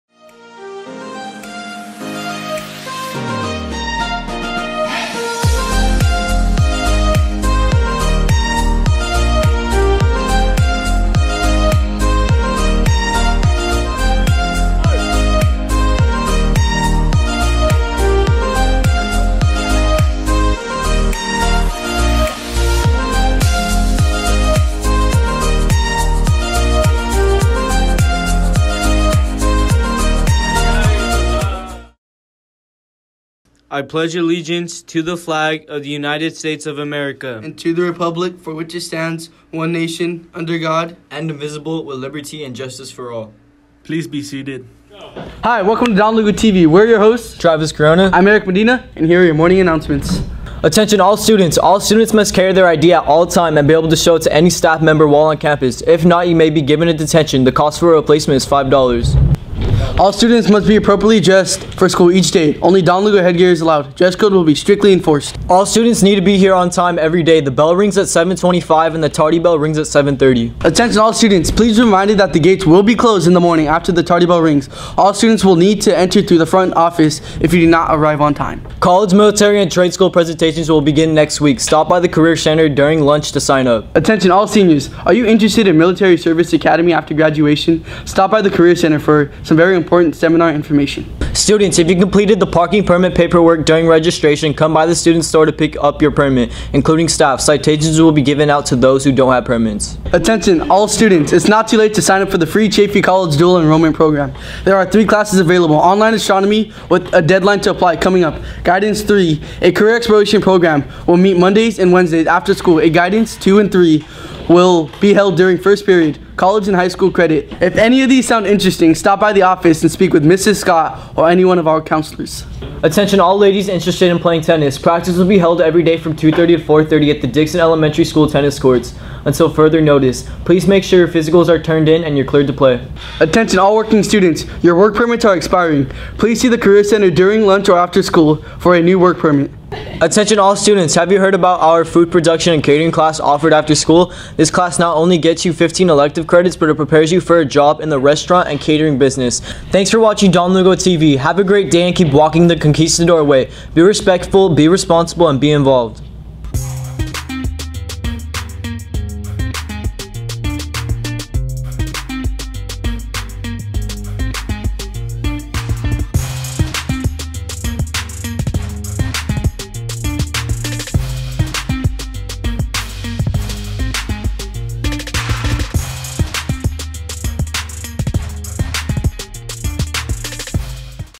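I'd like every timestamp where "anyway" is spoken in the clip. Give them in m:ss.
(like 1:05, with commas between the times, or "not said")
not said.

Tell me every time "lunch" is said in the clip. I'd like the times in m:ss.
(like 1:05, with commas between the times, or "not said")
1:23, 2:17.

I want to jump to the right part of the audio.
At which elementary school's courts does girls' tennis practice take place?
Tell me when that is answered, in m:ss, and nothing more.
2:07.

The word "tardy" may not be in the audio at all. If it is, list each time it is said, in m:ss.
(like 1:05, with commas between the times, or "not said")
1:09, 1:14.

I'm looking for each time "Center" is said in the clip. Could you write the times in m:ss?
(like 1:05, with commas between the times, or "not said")
1:22, 1:28, 2:16.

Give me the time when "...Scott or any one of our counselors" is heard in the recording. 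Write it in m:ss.
2:00.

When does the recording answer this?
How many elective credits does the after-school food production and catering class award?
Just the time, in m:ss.
2:25.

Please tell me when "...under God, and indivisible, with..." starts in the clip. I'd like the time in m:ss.
0:40.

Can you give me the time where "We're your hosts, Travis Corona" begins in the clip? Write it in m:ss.
0:46.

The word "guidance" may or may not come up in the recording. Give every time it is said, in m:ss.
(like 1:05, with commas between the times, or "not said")
1:48, 1:52.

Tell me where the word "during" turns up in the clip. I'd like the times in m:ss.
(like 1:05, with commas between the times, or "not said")
1:22, 1:33, 1:55, 2:17.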